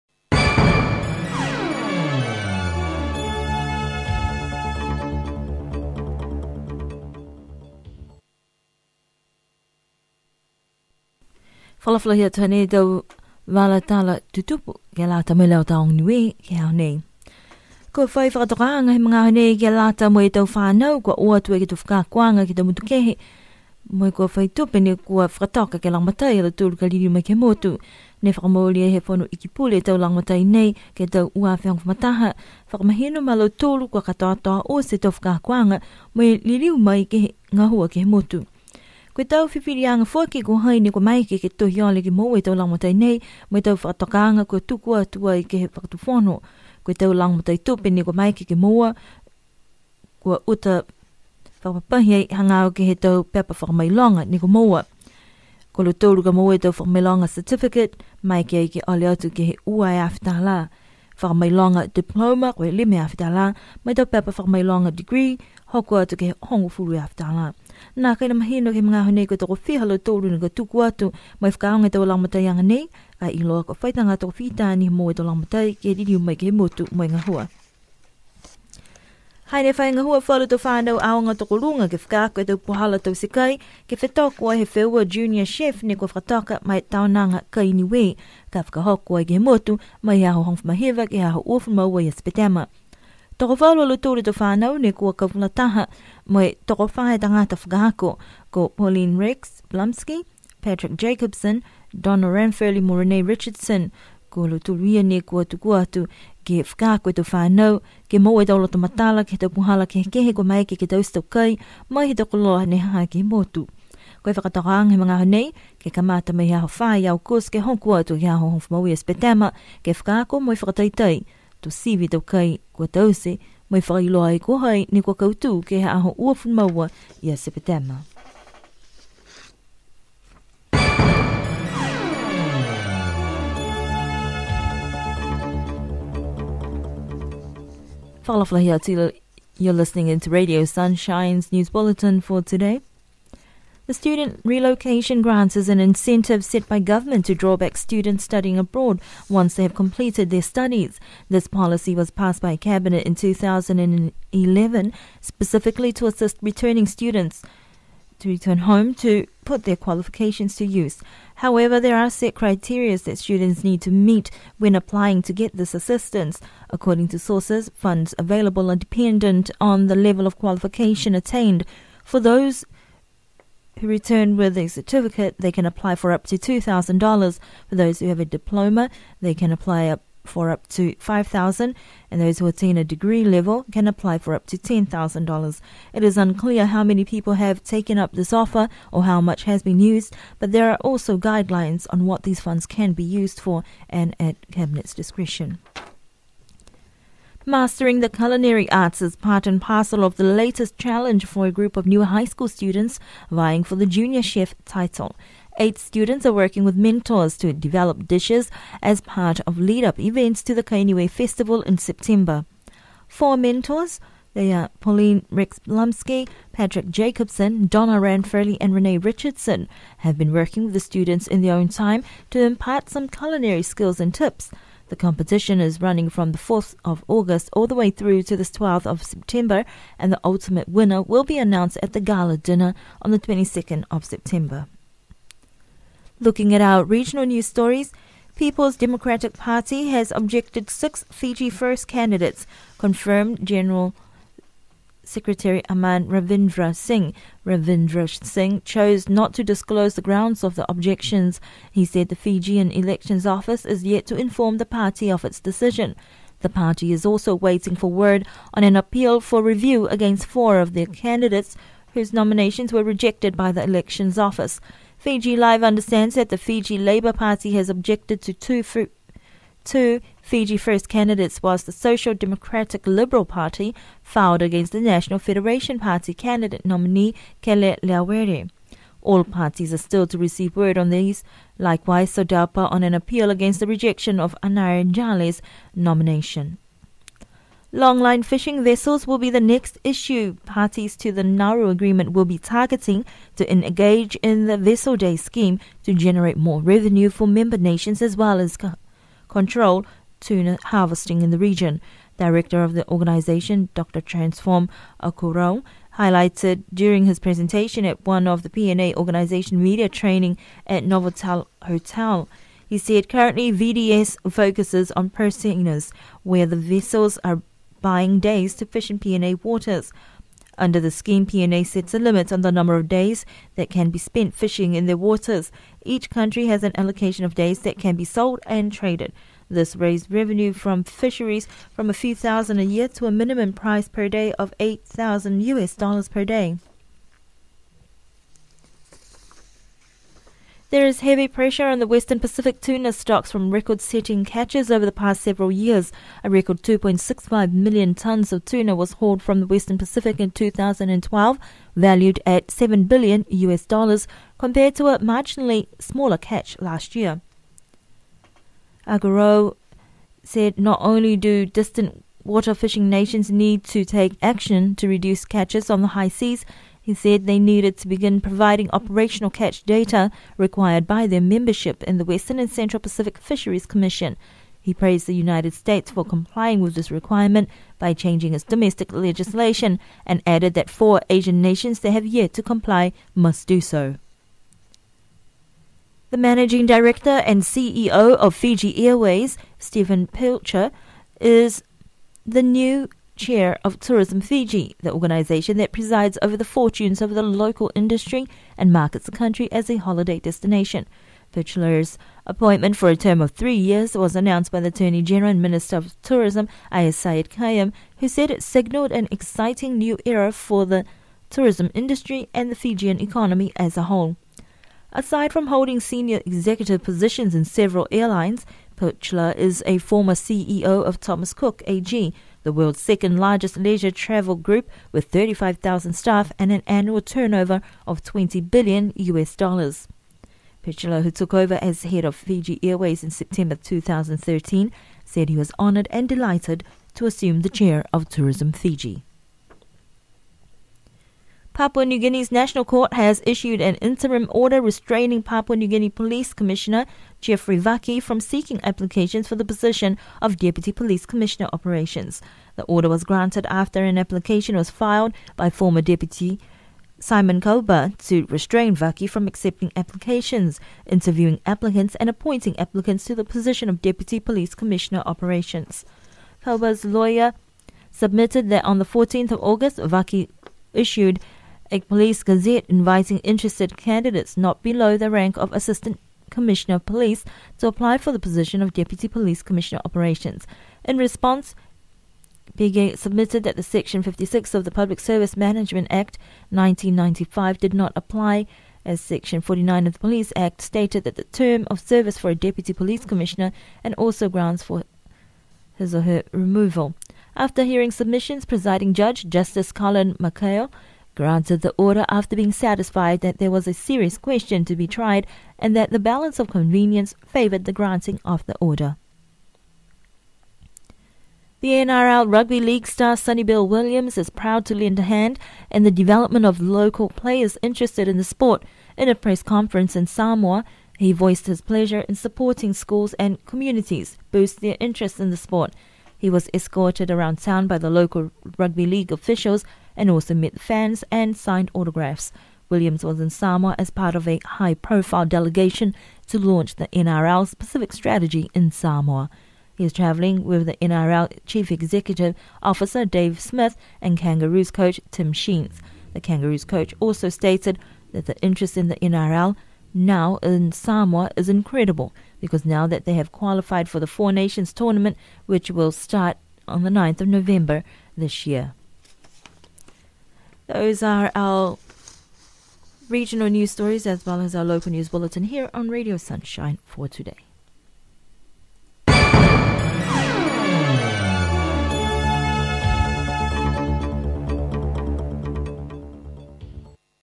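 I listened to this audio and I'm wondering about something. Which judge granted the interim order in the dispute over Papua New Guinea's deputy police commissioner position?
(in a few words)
Justice Colin Makail.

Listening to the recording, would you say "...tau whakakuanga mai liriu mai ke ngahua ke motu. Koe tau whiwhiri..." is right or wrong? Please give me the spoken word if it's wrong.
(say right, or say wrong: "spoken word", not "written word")
right.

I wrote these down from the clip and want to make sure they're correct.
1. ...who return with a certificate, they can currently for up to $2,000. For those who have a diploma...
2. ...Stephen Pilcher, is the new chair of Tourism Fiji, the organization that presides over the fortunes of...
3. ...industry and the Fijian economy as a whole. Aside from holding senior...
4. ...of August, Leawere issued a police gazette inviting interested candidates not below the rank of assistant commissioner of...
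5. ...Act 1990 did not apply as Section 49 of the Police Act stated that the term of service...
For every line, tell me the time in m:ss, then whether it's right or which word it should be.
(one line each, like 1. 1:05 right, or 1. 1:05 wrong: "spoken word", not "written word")
1. 2:53 wrong: "apply", not "currently"
2. 6:29 right
3. 6:51 right
4. 7:49 wrong: "Vaki", not "Leawere"
5. 8:05 wrong: "1995", not "1990".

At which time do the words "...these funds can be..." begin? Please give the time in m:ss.
3:12.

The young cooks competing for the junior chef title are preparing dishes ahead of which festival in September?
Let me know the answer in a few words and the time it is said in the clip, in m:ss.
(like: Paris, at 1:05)
Kainiwe Festival, at 3:30.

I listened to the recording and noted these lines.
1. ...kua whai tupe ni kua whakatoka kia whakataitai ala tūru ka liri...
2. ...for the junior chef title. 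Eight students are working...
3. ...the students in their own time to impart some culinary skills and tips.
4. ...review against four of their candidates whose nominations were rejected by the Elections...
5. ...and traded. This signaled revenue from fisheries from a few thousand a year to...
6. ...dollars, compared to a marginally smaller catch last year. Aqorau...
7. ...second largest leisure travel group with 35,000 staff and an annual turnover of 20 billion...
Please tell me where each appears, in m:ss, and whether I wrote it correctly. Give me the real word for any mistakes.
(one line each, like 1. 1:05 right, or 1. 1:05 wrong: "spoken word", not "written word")
1. 0:24 wrong: "langmatai", not "whakataitai"
2. 3:23 right
3. 3:40 right
4. 4:19 right
5. 5:28 wrong: "raised", not "signaled"
6. 5:53 right
7. 7:02 right.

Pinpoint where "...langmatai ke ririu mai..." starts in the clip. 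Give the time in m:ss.
1:15.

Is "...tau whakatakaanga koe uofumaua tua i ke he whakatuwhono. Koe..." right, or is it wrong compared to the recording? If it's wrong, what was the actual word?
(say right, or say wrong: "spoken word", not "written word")
wrong: "tukua", not "uofumaua".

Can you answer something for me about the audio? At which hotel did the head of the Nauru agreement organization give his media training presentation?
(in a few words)
Novotel Hotel.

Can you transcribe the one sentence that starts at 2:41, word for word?
However, there are set criteria that students need to meet when applying to get this assistance.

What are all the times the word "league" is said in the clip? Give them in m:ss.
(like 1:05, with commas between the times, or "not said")
8:32, 8:48.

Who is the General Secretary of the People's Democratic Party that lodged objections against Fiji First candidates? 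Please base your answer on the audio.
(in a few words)
Aman Ravindra Singh.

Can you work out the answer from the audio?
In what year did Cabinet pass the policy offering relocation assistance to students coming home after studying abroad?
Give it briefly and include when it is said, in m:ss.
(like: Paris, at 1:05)
2011, at 2:33.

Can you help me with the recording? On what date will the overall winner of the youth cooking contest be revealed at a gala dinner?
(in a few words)
22nd of September.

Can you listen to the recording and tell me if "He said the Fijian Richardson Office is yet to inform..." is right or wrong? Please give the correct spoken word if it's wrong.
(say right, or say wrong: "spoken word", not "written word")
wrong: "Elections", not "Richardson".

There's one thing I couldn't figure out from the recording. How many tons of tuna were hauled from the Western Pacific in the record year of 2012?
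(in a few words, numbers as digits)
2.65 million tons.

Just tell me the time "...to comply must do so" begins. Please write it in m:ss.
6:22.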